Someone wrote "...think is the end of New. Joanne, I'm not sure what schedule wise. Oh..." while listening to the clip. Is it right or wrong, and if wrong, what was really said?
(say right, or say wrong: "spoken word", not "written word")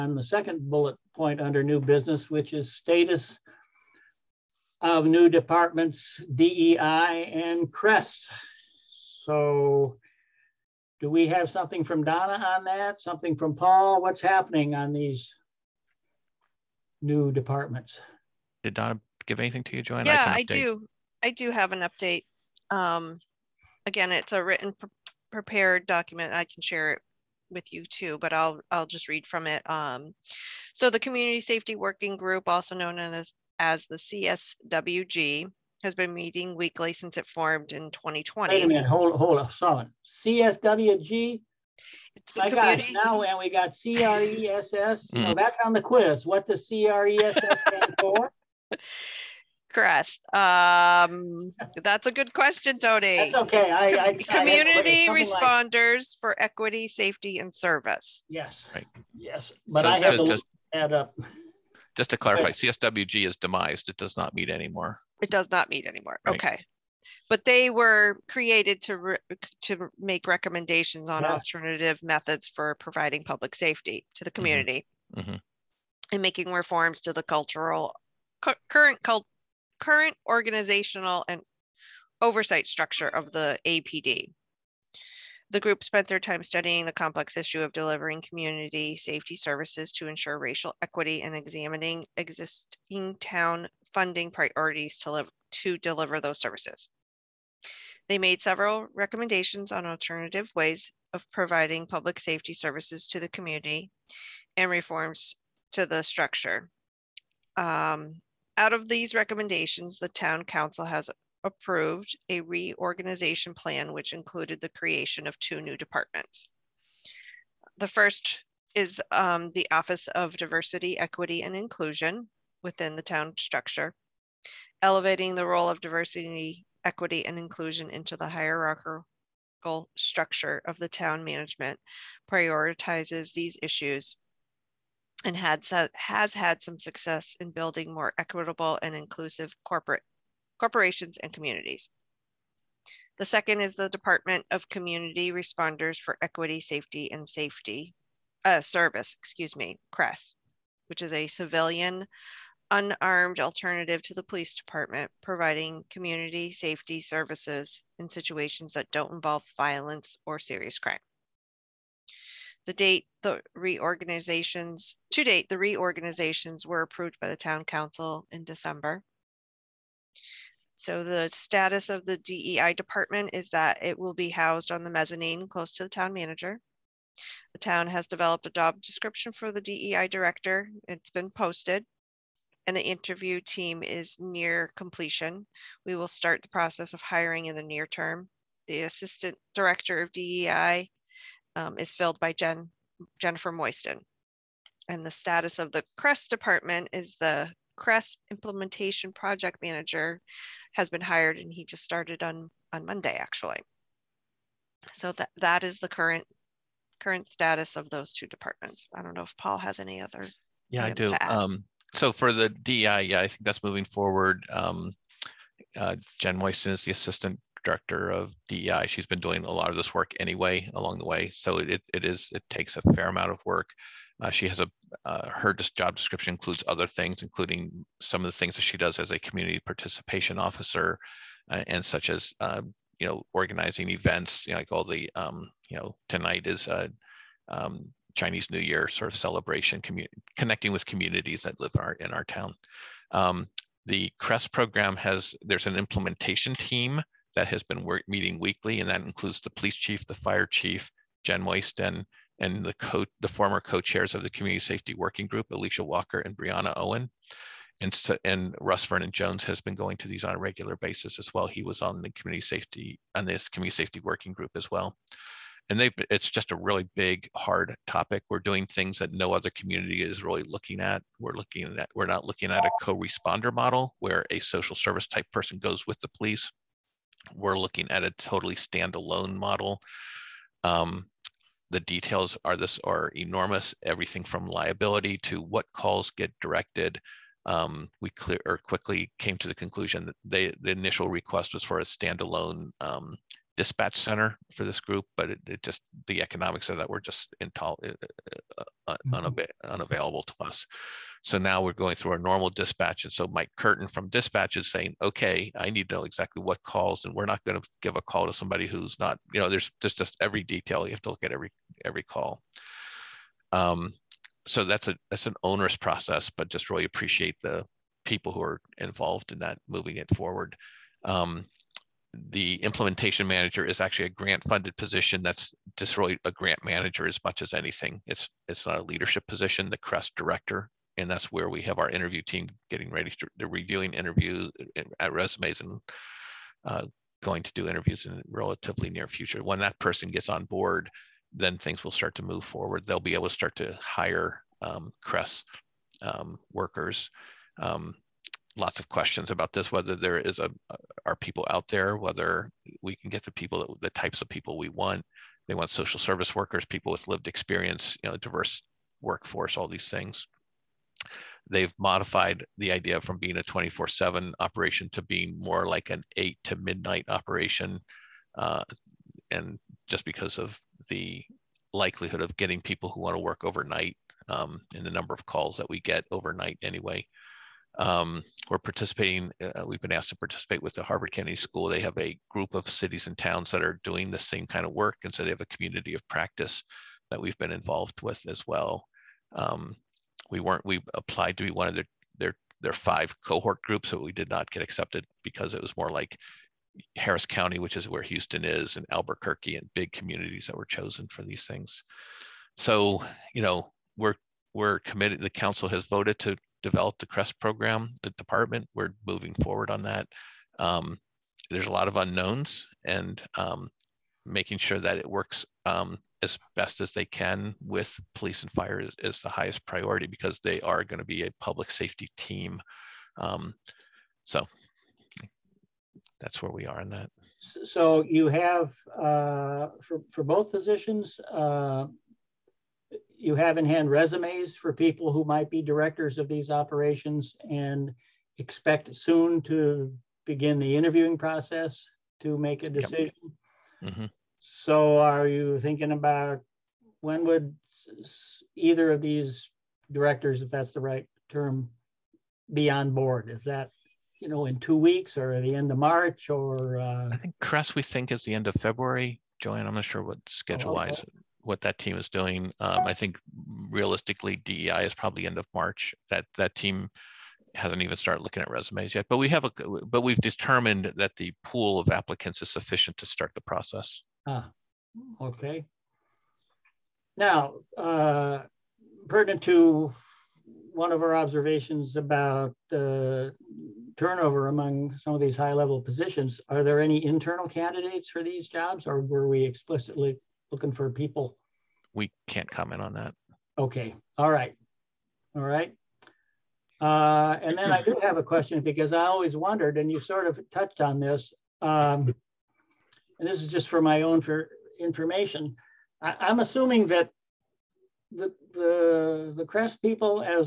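wrong: "February", not "New".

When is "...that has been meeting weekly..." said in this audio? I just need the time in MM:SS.
04:07.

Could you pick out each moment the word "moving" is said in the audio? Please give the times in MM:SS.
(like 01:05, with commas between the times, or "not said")
03:33, 05:19, 06:49.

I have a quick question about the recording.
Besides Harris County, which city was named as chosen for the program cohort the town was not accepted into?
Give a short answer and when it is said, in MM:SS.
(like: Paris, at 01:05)
Albuquerque, at 06:38.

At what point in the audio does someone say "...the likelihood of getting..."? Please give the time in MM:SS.
06:10.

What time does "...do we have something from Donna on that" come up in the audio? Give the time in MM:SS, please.
00:10.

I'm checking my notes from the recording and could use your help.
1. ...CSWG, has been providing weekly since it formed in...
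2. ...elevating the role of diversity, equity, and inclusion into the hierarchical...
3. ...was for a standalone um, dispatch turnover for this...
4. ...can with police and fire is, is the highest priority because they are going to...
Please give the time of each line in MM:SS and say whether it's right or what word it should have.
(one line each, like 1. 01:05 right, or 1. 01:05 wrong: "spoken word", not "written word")
1. 00:33 wrong: "meeting", not "providing"
2. 02:04 right
3. 04:51 wrong: "center", not "turnover"
4. 06:57 right.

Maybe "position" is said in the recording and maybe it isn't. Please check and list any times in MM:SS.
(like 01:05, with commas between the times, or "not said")
05:24, 05:29, 07:10, 08:05.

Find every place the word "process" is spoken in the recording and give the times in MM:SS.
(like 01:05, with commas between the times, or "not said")
03:06, 05:15, 07:21, 07:53.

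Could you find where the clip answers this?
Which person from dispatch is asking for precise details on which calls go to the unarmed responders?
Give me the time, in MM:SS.
05:03.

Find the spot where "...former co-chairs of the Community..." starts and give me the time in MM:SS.
04:13.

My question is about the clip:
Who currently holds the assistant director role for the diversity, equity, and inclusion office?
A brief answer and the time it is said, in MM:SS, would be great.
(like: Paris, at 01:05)
Jennifer Moyston, at 03:13.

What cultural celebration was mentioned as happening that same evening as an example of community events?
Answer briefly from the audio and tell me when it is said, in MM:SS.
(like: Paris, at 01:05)
Chinese New Year, at 03:58.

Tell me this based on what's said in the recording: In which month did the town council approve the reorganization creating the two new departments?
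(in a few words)
December.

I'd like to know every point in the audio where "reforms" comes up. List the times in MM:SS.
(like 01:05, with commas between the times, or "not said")
01:16, 01:44.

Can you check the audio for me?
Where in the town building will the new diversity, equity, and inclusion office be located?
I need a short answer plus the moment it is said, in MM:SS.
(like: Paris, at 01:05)
The mezzanine, at 02:54.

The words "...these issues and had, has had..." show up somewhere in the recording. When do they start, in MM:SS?
02:13.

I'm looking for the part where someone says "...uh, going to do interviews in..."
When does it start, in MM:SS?
05:36.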